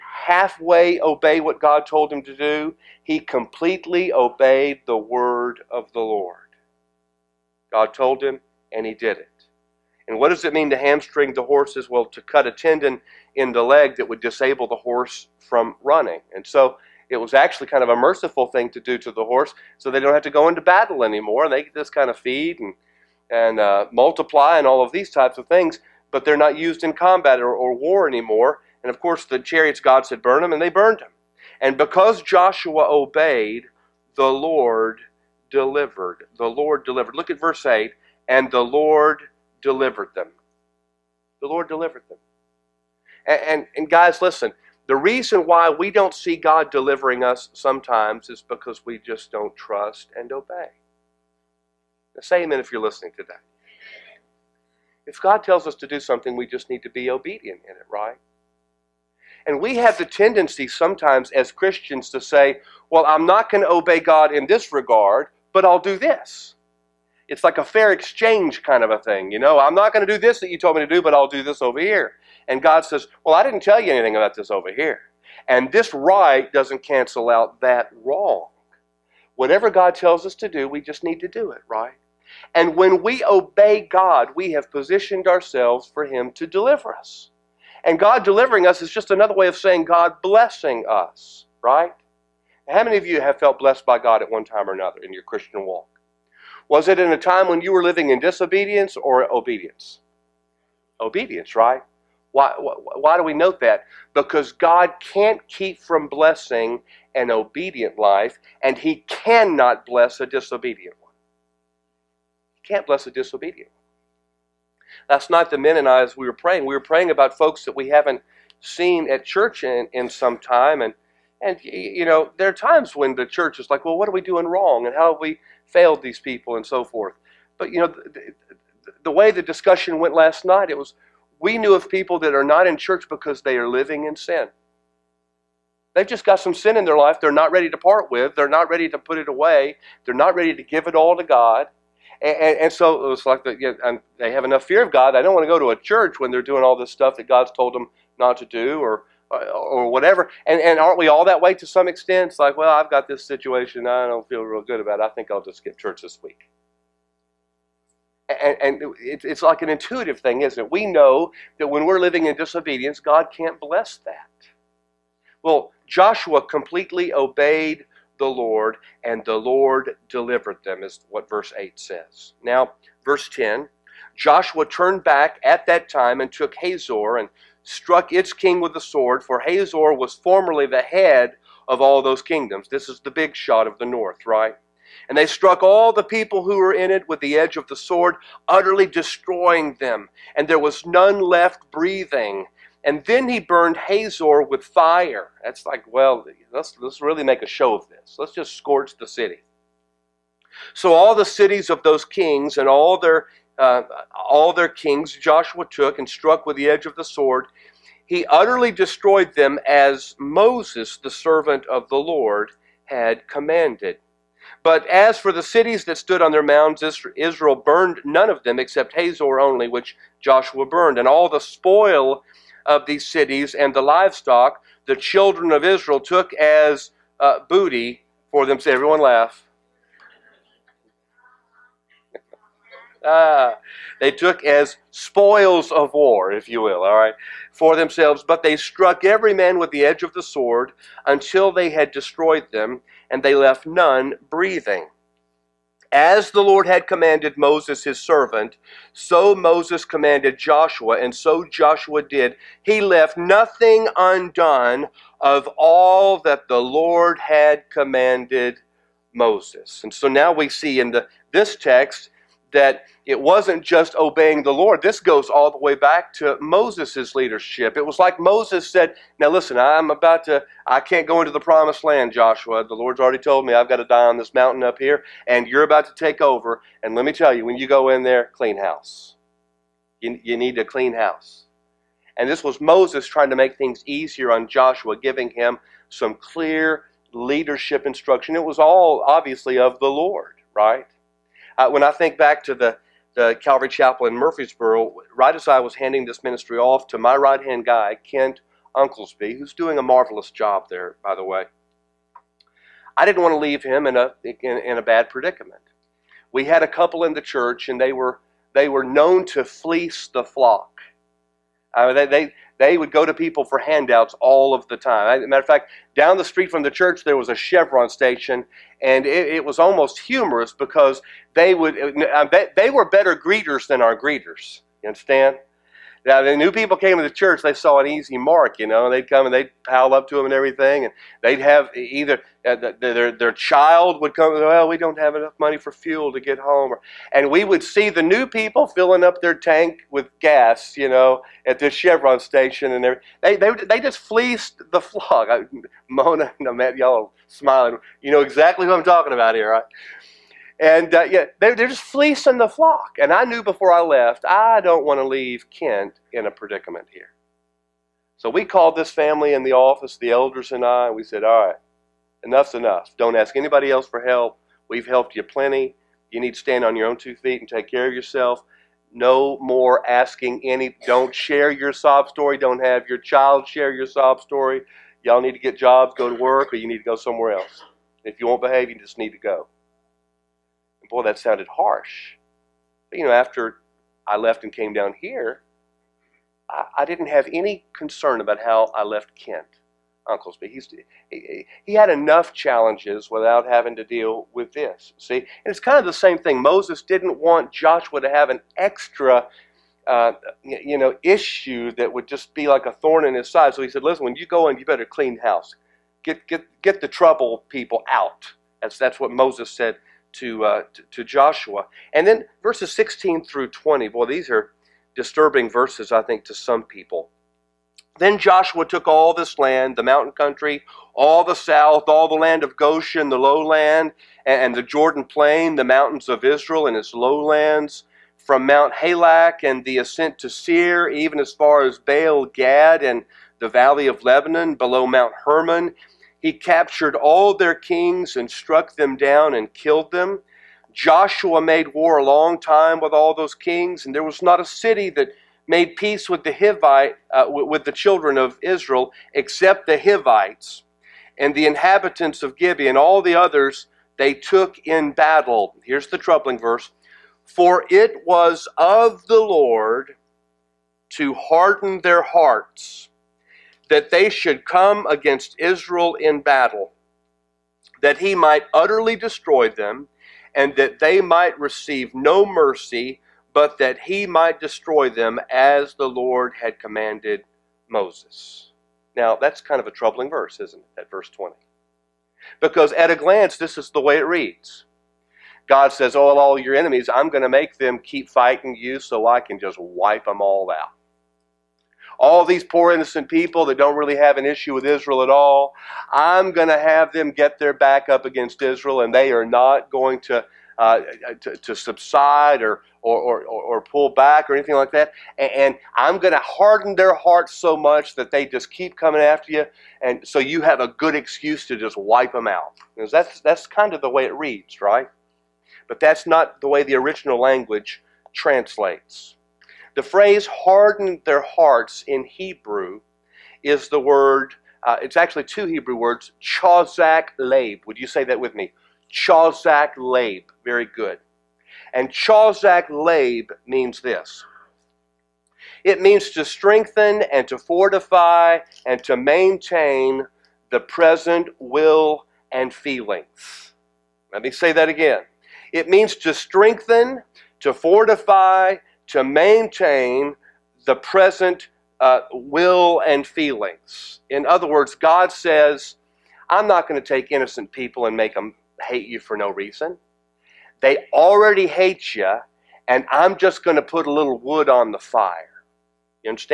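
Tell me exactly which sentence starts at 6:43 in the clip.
So he said, listen, when you go in, you better clean house.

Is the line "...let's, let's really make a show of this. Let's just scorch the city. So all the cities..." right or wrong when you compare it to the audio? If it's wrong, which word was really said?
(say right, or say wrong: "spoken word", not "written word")
right.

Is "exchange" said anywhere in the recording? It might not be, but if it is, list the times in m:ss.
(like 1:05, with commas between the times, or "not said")
1:07.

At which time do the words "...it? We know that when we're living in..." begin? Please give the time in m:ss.
2:40.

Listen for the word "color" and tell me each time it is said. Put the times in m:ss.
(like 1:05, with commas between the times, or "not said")
not said.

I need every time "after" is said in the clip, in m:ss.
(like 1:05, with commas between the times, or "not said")
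6:23, 8:29.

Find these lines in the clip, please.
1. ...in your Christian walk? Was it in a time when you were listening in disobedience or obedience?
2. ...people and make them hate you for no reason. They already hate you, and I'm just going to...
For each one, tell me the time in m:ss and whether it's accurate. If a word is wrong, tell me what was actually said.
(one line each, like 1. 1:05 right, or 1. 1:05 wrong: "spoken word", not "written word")
1. 1:35 wrong: "living", not "listening"
2. 9:17 right.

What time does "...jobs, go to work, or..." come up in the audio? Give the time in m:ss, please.
6:15.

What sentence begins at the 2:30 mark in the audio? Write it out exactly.
And, and aren't we all that way to some extent?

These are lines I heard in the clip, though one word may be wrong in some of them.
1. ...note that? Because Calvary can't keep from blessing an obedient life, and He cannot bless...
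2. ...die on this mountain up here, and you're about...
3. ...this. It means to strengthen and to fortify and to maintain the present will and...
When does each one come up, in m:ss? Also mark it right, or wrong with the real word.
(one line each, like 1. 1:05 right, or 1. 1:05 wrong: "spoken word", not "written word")
1. 1:43 wrong: "God", not "Calvary"
2. 4:33 right
3. 8:53 right.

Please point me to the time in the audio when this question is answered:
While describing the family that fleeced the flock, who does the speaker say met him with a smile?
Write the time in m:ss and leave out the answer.
5:45.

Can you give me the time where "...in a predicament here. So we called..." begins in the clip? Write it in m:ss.
5:56.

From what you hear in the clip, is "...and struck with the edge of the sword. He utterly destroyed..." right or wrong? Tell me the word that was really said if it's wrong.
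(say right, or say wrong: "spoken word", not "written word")
right.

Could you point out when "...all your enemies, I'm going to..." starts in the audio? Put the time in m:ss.
8:06.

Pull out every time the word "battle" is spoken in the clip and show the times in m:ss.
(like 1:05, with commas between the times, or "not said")
0:20, 7:34, 7:46.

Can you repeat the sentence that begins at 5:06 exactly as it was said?
We had a couple in the church, and they were, they were known to fleece the flock.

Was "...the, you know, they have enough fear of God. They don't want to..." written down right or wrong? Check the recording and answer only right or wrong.
right.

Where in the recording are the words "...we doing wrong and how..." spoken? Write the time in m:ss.
2:04.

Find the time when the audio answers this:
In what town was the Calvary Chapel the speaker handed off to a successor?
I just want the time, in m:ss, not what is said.
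4:54.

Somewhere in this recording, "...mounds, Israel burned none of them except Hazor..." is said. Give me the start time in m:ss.
3:36.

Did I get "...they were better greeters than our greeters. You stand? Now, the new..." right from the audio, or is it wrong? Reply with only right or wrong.
wrong.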